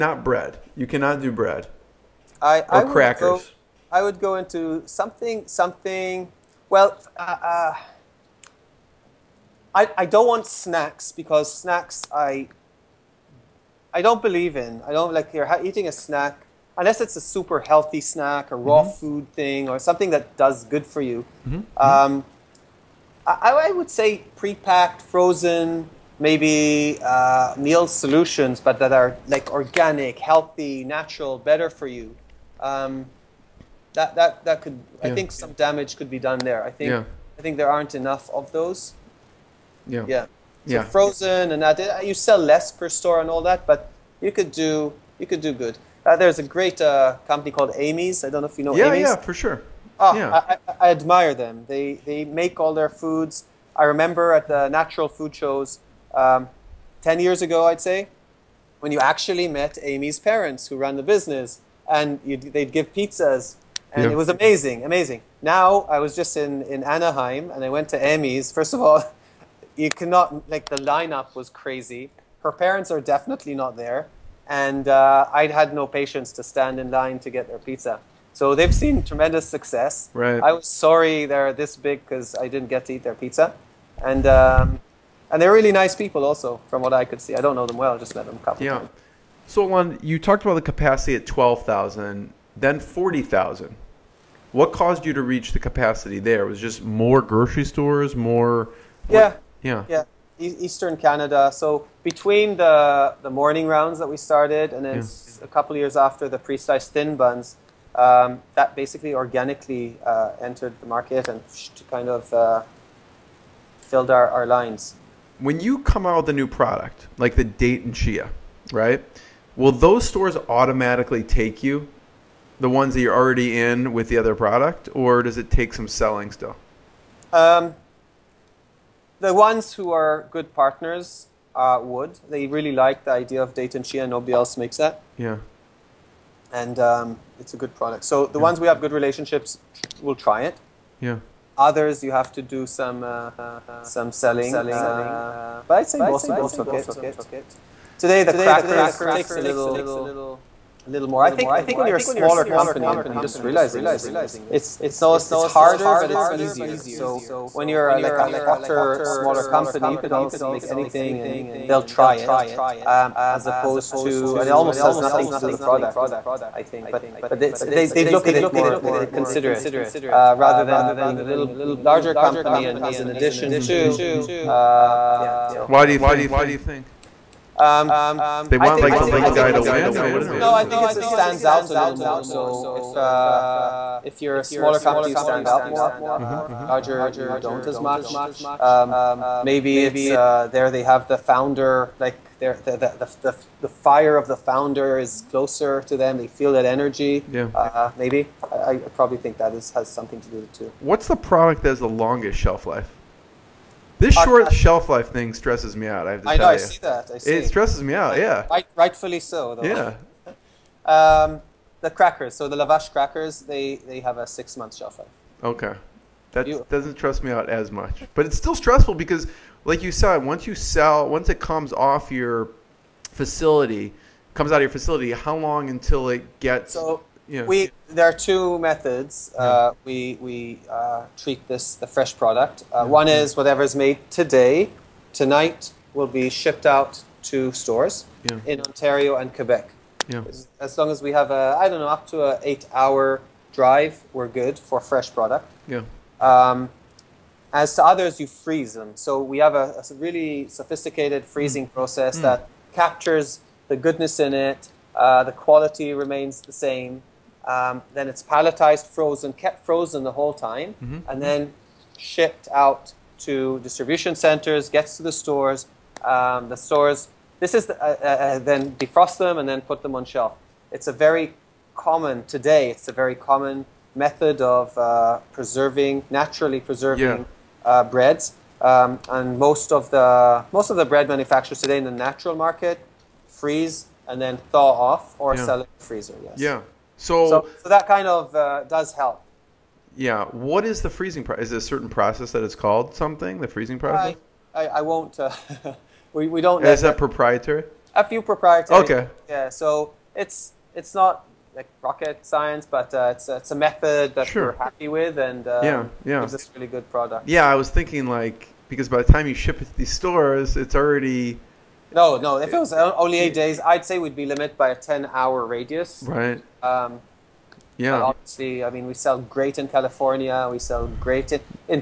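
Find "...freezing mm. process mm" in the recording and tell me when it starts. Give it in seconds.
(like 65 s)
251 s.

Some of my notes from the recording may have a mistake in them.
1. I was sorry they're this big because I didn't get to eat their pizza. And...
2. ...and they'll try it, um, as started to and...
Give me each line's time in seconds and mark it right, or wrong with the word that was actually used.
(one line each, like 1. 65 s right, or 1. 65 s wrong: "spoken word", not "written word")
1. 80 s right
2. 161 s wrong: "opposed", not "started".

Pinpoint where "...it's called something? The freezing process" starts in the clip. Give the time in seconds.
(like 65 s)
292 s.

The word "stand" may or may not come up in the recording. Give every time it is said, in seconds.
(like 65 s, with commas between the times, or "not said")
76 s, 180 s, 185 s.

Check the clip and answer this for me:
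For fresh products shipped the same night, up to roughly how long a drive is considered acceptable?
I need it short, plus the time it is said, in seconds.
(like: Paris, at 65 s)
8 hours, at 242 s.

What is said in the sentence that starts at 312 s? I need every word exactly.
If it was only eight days, I'd say we'd be limited by a ten-hour radius.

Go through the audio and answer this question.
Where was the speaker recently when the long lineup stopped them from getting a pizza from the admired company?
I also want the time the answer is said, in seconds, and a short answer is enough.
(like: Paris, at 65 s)
Anaheim, at 66 s.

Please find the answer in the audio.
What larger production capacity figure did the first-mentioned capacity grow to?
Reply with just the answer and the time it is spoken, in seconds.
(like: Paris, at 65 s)
40,000, at 92 s.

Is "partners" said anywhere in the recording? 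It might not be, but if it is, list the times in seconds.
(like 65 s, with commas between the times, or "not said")
130 s.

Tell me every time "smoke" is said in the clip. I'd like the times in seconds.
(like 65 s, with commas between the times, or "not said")
not said.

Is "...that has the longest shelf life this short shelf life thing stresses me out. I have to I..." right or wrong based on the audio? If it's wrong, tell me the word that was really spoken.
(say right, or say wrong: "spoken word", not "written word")
right.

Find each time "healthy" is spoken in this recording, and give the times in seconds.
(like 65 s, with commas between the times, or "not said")
17 s, 30 s.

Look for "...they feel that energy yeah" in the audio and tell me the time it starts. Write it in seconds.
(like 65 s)
196 s.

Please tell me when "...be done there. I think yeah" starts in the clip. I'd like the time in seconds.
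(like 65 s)
36 s.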